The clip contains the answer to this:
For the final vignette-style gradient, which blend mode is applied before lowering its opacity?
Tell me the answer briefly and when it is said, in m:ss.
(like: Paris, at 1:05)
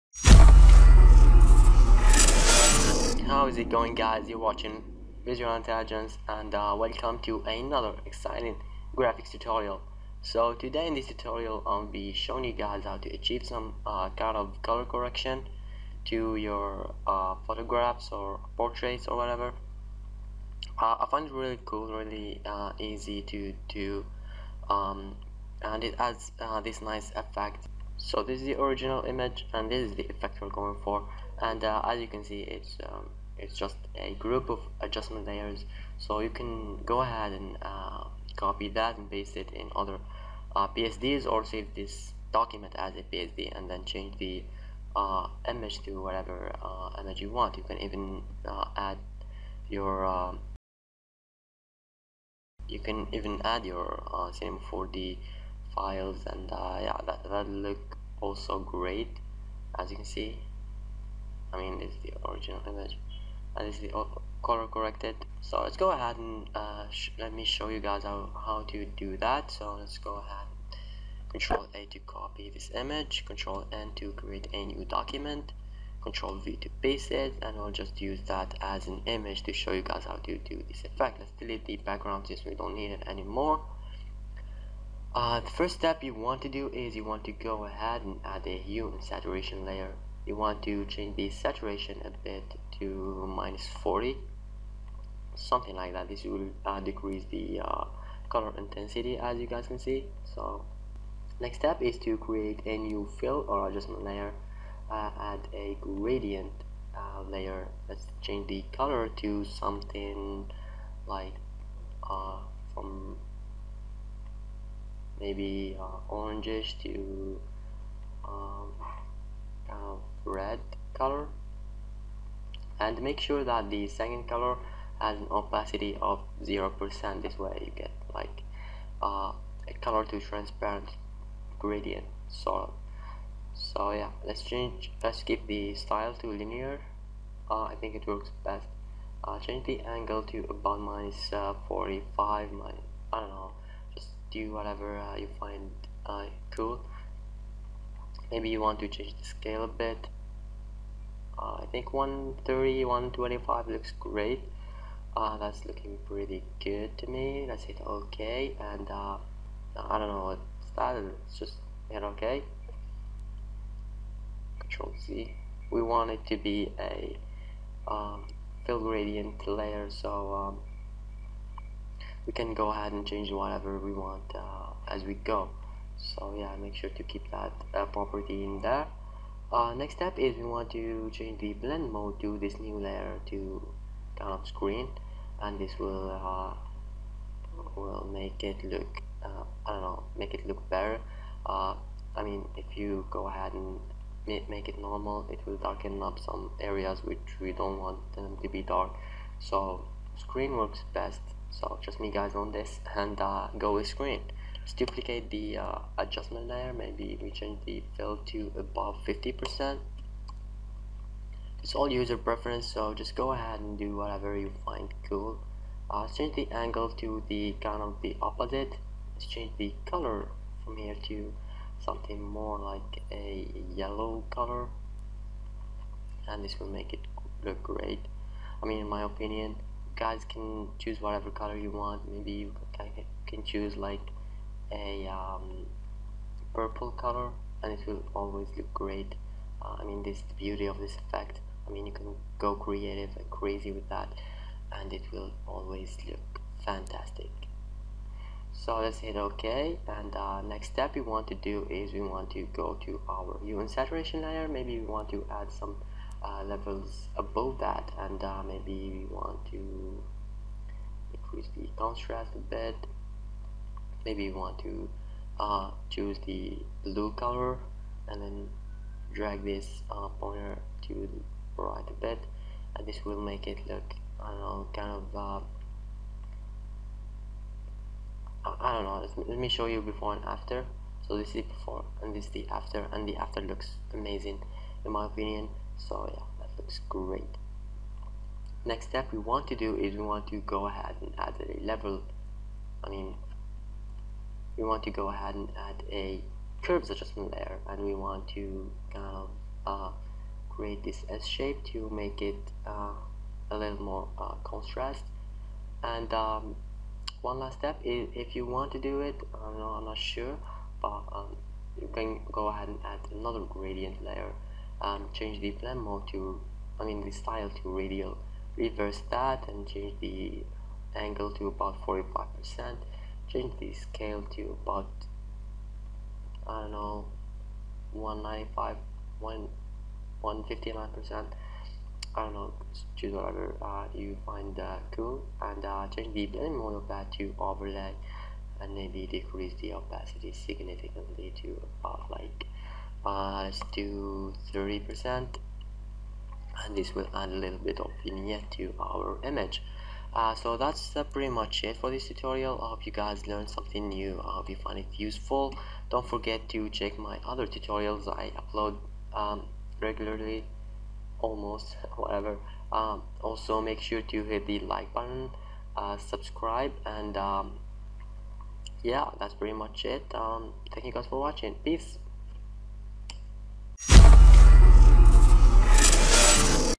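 Overlay, at 5:37.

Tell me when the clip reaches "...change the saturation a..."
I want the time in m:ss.
1:30.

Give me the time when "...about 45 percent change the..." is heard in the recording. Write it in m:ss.
5:21.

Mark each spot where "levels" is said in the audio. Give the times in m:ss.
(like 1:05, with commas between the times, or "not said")
4:16, 4:51.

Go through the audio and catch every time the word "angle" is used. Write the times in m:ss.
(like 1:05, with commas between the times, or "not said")
2:19, 3:36, 5:20.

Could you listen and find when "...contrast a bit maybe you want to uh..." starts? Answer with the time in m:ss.
4:21.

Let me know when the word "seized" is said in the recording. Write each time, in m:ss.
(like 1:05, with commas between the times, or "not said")
not said.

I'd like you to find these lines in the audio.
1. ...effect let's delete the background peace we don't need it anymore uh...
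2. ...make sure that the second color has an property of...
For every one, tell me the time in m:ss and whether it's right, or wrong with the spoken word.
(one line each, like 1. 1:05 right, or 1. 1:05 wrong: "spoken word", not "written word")
1. 1:20 wrong: "since", not "peace"
2. 2:03 wrong: "opacity", not "property".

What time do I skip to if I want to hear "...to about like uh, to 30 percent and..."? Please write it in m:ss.
5:41.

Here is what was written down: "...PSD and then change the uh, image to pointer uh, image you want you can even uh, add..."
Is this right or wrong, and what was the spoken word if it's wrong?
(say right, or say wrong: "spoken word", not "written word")
wrong: "whatever", not "pointer".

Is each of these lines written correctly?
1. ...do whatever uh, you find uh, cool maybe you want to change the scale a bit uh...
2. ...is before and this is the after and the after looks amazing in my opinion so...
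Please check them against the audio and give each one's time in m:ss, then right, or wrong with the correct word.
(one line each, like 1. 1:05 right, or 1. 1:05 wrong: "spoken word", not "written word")
1. 2:24 right
2. 4:41 right.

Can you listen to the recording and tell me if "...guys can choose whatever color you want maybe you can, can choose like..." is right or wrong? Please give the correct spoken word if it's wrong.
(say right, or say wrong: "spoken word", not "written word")
right.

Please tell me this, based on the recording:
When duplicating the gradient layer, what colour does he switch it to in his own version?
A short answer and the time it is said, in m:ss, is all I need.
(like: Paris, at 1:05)
Yellow, at 3:43.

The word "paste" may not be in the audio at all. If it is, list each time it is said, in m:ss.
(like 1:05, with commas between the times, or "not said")
0:39, 1:16.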